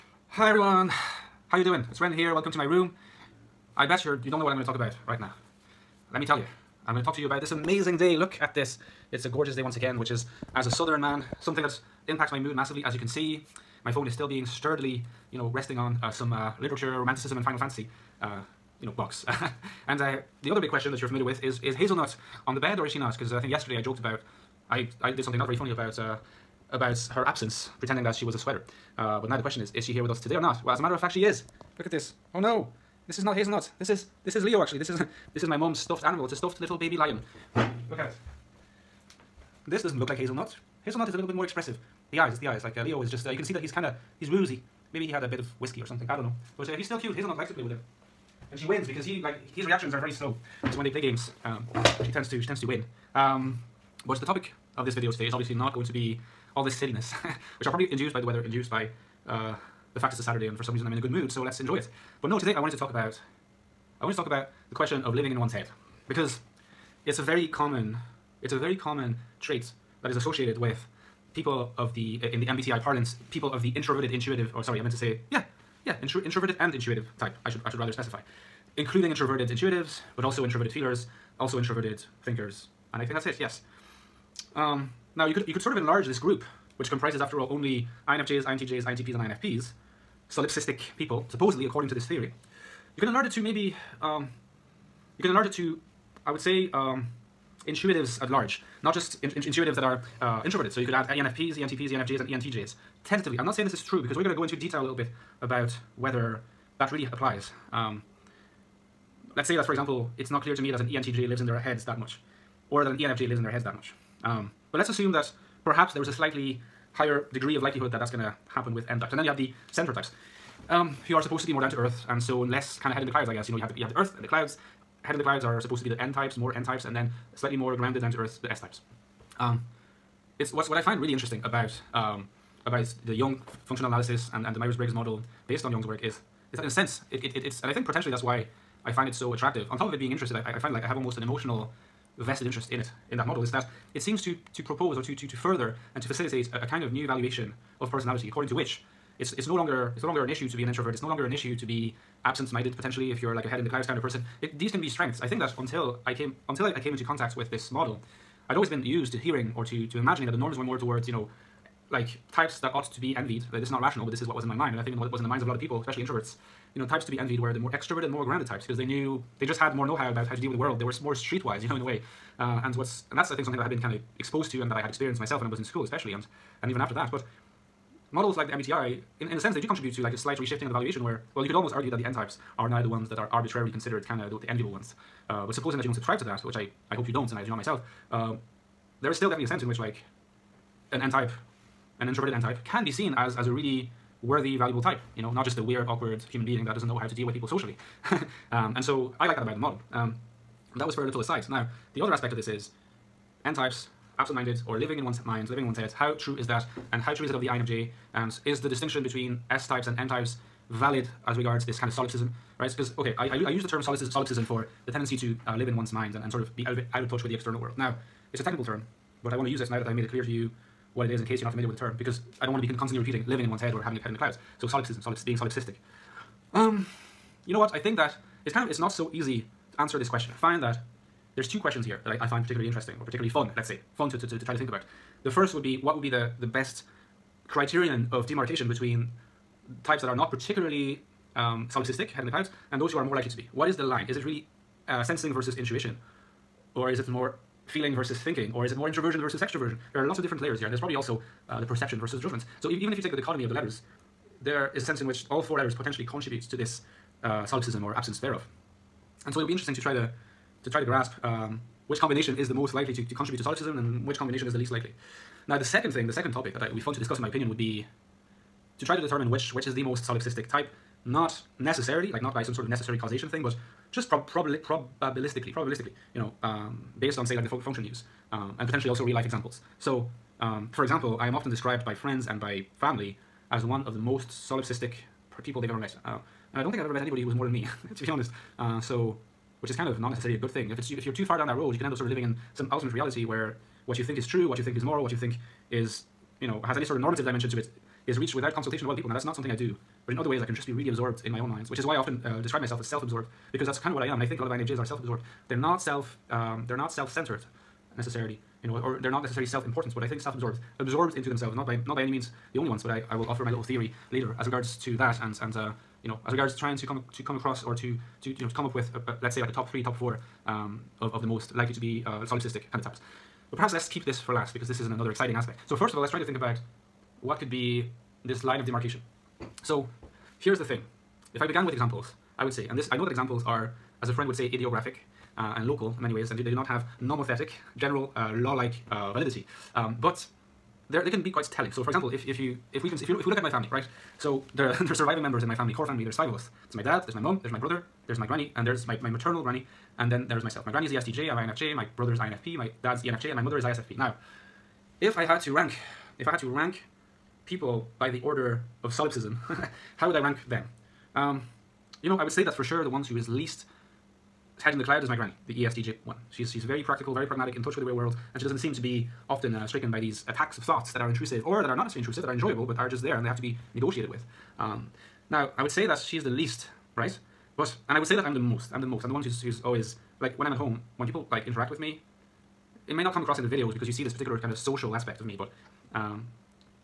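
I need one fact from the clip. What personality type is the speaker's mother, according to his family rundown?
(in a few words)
ISFP.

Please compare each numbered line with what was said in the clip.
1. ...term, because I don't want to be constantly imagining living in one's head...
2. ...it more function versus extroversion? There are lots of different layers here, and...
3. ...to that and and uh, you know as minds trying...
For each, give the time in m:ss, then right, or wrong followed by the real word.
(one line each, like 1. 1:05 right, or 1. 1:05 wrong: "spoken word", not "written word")
1. 3:41 wrong: "repeating", not "imagining"
2. 4:08 wrong: "introversion", not "function"
3. 5:14 wrong: "regards", not "minds".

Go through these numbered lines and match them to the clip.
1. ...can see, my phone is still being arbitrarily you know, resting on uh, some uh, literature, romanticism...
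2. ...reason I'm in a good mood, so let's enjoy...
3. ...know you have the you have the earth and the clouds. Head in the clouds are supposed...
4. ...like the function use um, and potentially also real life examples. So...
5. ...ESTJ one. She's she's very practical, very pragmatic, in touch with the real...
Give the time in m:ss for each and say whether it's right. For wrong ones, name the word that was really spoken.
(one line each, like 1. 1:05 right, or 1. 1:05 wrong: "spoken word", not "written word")
1. 0:12 wrong: "sturdily", not "arbitrarily"
2. 1:00 right
3. 2:03 right
4. 4:37 right
5. 6:05 right.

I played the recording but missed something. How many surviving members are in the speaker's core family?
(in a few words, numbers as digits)
5.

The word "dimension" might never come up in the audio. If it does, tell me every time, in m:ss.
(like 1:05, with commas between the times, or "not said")
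4:57.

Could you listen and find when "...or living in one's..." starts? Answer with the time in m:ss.
3:24.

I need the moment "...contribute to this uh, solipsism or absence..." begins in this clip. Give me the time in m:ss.
4:16.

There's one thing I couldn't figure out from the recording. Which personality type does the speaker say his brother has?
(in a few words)
INFP.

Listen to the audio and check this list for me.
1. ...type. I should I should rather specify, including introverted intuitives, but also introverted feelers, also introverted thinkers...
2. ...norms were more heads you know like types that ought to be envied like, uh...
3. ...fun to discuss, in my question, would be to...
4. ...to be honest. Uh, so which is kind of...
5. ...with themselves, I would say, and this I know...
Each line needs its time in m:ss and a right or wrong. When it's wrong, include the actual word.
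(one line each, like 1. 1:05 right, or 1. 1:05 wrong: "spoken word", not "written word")
1. 1:17 right
2. 2:40 wrong: "towards", not "heads"
3. 4:26 wrong: "opinion", not "question"
4. 4:47 right
5. 5:31 wrong: "examples", not "themselves".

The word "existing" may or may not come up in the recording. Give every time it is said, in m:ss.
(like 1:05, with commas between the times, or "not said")
not said.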